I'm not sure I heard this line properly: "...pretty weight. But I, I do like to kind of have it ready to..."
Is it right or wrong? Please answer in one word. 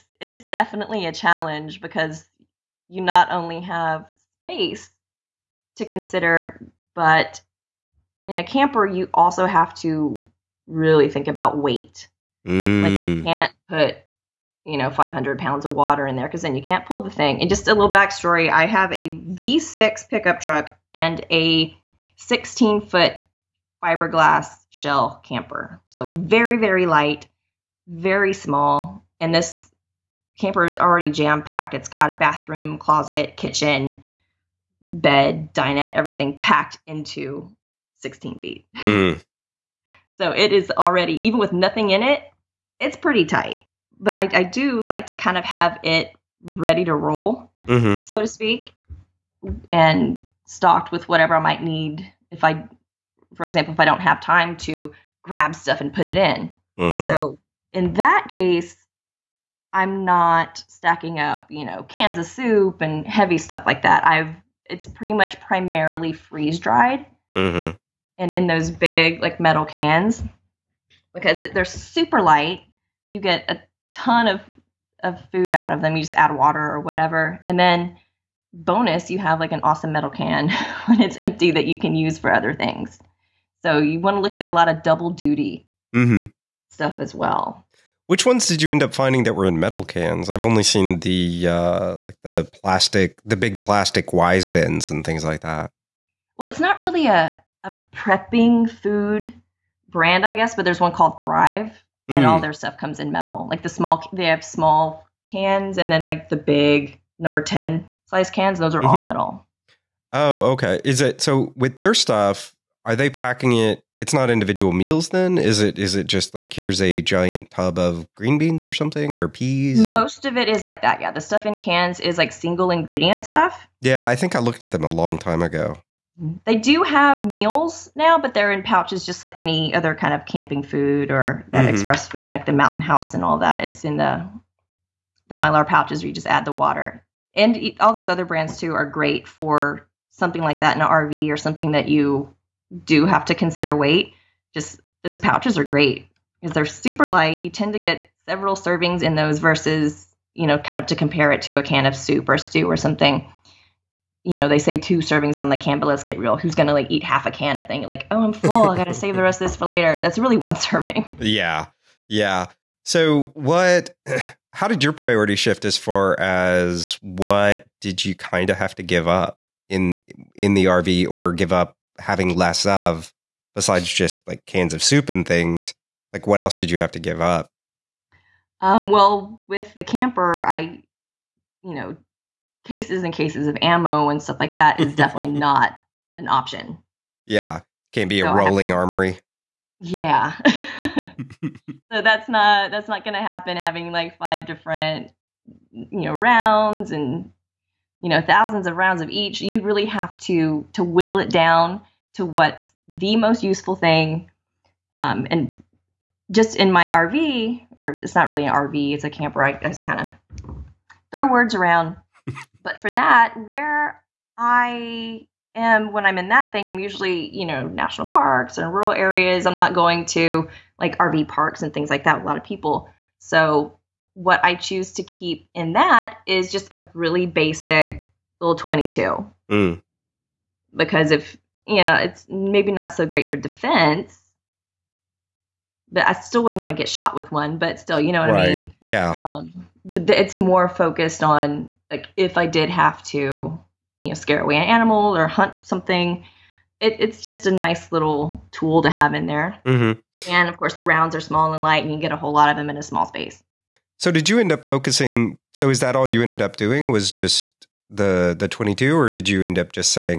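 wrong.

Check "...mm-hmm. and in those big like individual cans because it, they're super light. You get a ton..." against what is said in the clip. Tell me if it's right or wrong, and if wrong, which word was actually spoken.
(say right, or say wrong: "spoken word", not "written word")
wrong: "metal", not "individual".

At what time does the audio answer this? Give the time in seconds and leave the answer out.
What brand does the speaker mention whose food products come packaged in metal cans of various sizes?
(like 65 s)
101 s.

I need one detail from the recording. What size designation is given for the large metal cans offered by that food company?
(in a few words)
number ten.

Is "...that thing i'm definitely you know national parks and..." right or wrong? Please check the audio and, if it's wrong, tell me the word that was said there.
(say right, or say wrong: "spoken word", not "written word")
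wrong: "usually", not "definitely".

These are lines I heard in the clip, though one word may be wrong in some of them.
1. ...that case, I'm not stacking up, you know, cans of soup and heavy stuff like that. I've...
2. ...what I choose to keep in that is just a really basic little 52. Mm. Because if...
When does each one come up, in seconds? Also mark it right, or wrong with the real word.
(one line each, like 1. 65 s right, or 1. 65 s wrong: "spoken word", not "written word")
1. 57 s right
2. 224 s wrong: "22", not "52".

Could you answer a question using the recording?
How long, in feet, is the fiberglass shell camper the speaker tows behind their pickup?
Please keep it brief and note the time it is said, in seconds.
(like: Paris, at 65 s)
16 feet, at 22 s.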